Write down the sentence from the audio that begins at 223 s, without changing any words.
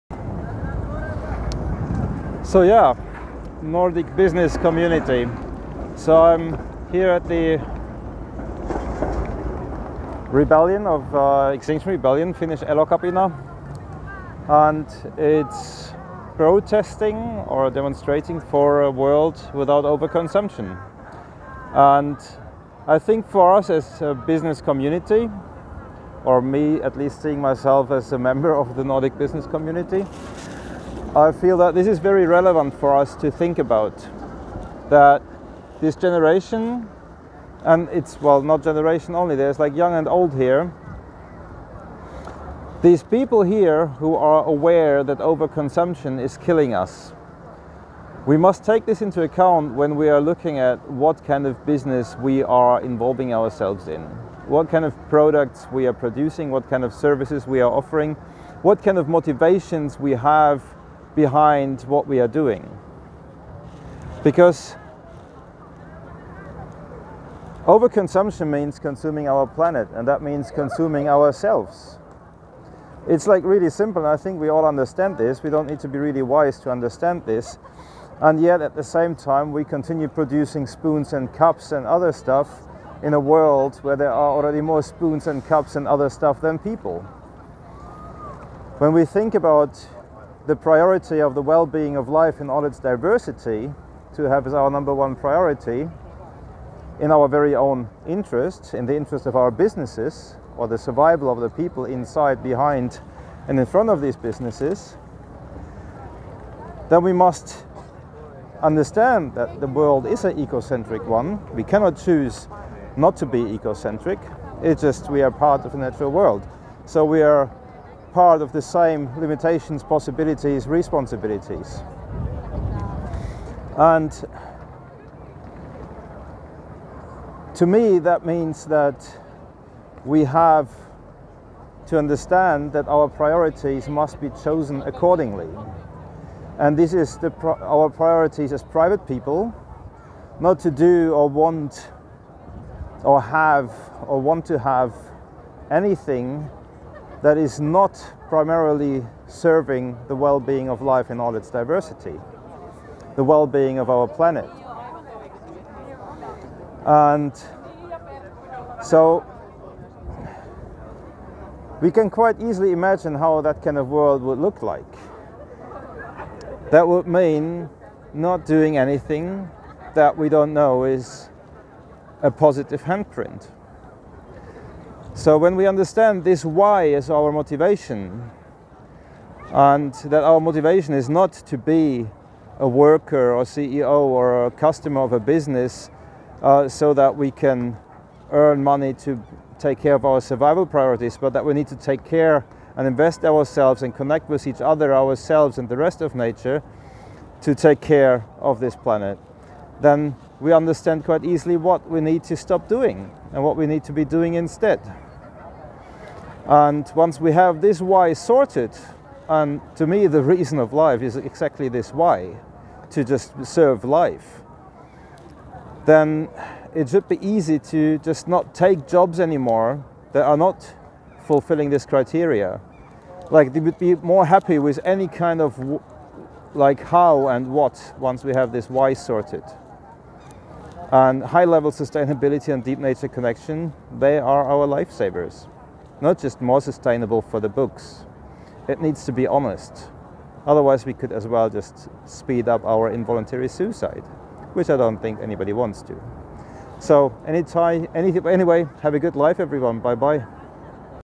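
Like they would be more happy with any kind of like how and what once we have this why sorted.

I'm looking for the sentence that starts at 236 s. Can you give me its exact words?
Not just more sustainable for the books.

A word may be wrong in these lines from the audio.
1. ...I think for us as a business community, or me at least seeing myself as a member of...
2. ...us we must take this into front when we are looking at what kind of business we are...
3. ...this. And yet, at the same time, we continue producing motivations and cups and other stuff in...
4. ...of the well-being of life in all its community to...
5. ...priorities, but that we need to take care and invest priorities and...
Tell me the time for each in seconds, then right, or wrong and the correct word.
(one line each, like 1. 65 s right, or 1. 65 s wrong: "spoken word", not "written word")
1. 22 s right
2. 46 s wrong: "account", not "front"
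3. 77 s wrong: "spoons", not "motivations"
4. 91 s wrong: "diversity", not "community"
5. 190 s wrong: "ourselves", not "priorities".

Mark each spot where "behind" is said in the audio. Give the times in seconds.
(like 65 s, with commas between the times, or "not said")
61 s, 102 s.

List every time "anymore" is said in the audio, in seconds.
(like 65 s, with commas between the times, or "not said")
219 s.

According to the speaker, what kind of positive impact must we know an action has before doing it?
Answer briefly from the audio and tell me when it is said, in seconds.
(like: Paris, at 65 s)
Positive handprint, at 172 s.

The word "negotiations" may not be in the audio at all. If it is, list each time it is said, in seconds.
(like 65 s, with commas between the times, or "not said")
not said.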